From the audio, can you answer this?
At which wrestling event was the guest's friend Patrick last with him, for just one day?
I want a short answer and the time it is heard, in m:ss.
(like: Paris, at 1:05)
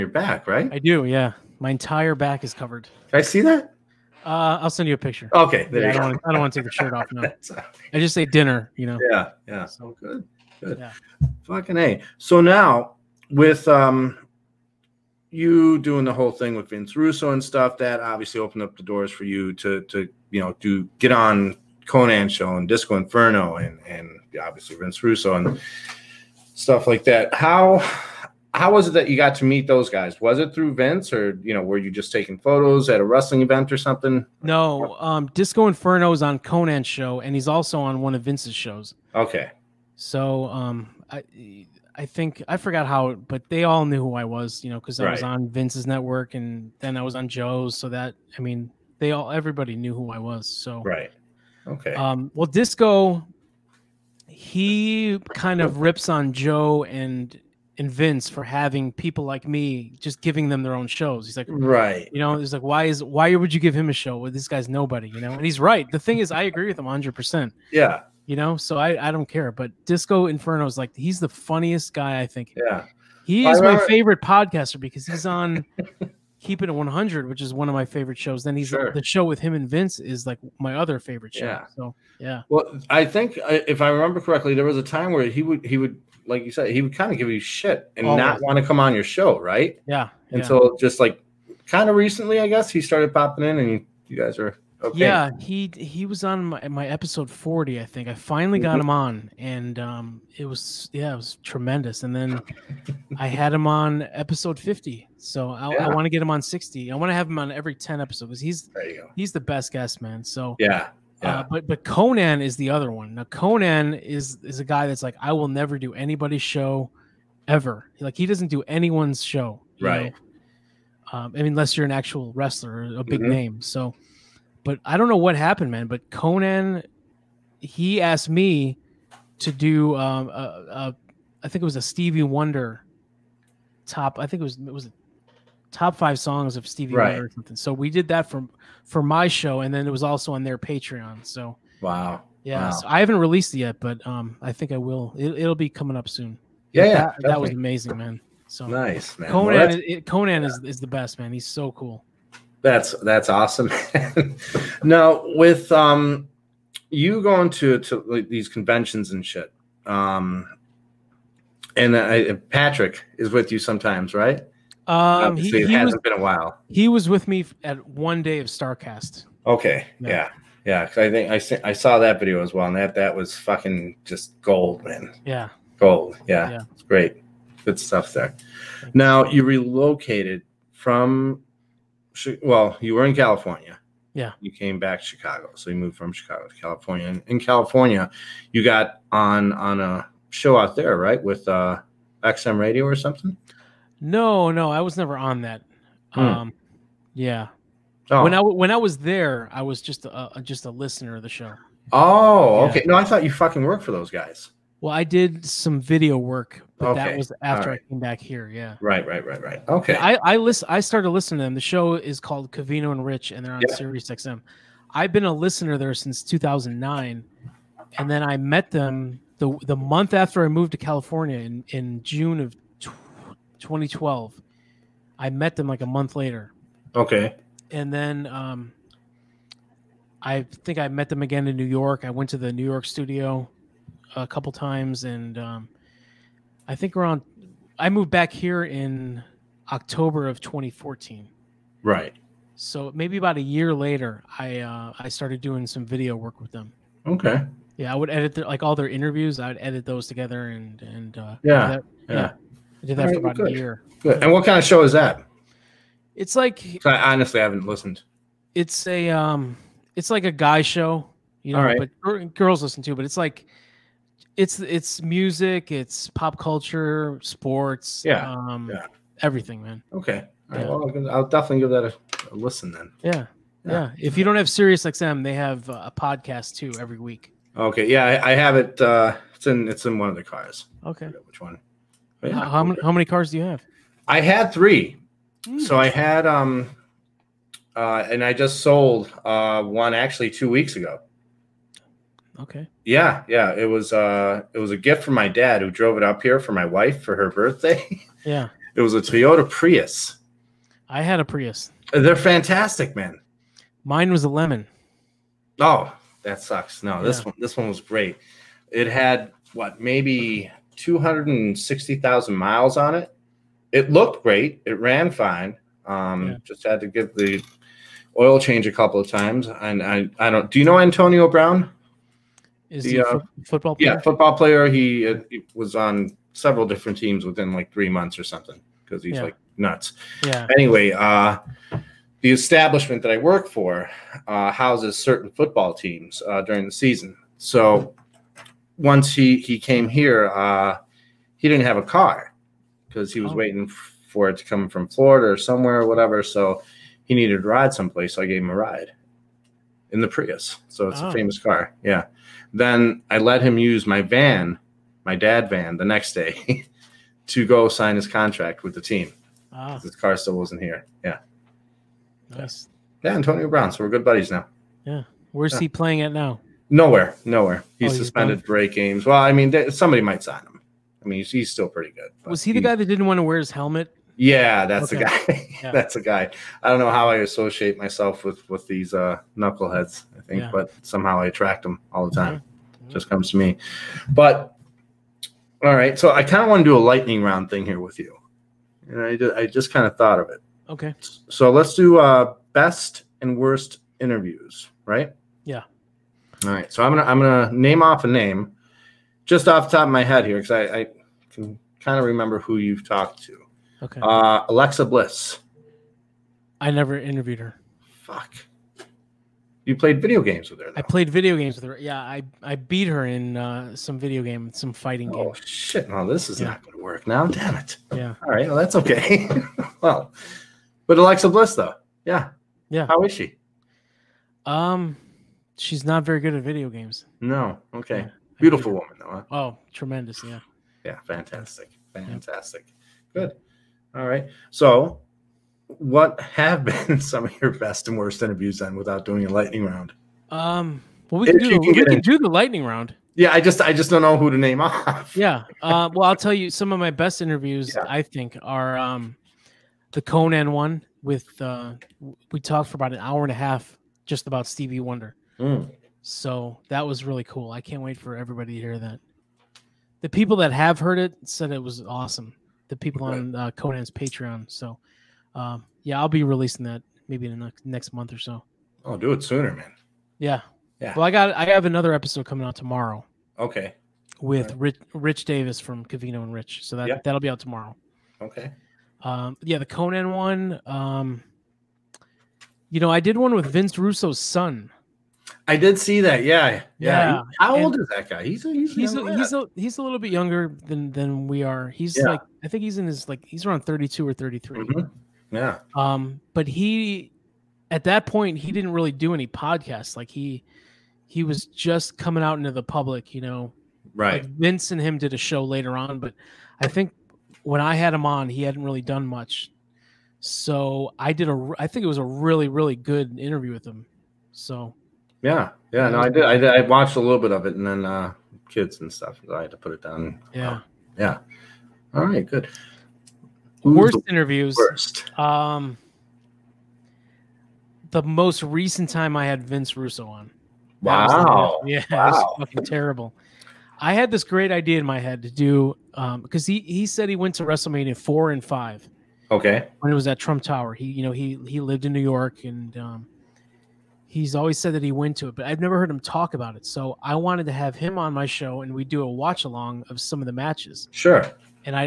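Starrcast, at 2:48.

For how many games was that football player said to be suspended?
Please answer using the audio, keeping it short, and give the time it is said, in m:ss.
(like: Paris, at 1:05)
8, at 6:08.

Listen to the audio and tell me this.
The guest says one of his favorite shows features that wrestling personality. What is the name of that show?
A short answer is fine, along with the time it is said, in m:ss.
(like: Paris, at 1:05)
Keeping It 100, at 1:16.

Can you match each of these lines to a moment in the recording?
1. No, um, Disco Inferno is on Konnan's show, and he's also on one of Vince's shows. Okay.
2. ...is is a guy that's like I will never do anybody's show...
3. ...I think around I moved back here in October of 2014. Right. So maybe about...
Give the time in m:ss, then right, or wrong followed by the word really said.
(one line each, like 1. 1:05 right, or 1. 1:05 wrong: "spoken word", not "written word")
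1. 0:34 right
2. 1:53 right
3. 3:56 right.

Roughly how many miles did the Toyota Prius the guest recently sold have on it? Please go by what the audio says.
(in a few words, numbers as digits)
260,000.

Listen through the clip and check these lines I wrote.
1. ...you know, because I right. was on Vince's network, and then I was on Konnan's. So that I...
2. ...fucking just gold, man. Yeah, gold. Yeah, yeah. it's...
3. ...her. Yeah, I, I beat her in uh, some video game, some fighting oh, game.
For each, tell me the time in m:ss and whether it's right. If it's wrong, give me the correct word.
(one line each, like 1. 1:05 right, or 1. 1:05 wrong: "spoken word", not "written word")
1. 0:44 wrong: "Joe", not "Konnan"
2. 2:53 right
3. 6:51 right.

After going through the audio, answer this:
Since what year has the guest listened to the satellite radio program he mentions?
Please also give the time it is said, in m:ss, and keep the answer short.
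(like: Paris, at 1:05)
2009, at 3:36.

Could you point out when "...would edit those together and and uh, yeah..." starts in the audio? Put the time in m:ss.
4:09.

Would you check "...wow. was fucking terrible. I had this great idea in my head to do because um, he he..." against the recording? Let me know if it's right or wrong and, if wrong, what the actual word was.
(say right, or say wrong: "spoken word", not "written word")
right.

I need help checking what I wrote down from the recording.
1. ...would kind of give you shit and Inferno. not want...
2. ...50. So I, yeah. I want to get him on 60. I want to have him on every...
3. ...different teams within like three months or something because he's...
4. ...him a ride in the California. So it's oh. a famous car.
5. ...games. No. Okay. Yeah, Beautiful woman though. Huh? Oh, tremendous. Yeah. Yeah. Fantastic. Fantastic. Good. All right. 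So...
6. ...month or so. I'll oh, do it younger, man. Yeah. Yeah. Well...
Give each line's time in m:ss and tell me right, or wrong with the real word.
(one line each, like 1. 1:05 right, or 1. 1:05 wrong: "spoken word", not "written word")
1. 1:26 wrong: "Always", not "Inferno"
2. 1:44 right
3. 5:26 right
4. 5:48 wrong: "Prius", not "California"
5. 7:06 right
6. 7:47 wrong: "sooner", not "younger".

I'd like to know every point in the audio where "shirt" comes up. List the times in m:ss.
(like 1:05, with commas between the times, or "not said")
0:06.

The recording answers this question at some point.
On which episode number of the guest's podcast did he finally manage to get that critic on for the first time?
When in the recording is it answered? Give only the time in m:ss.
1:36.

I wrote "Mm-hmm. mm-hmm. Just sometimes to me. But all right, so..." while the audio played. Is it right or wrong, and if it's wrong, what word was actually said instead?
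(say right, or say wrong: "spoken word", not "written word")
wrong: "comes", not "sometimes".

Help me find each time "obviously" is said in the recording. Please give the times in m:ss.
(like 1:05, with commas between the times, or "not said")
0:17, 0:24.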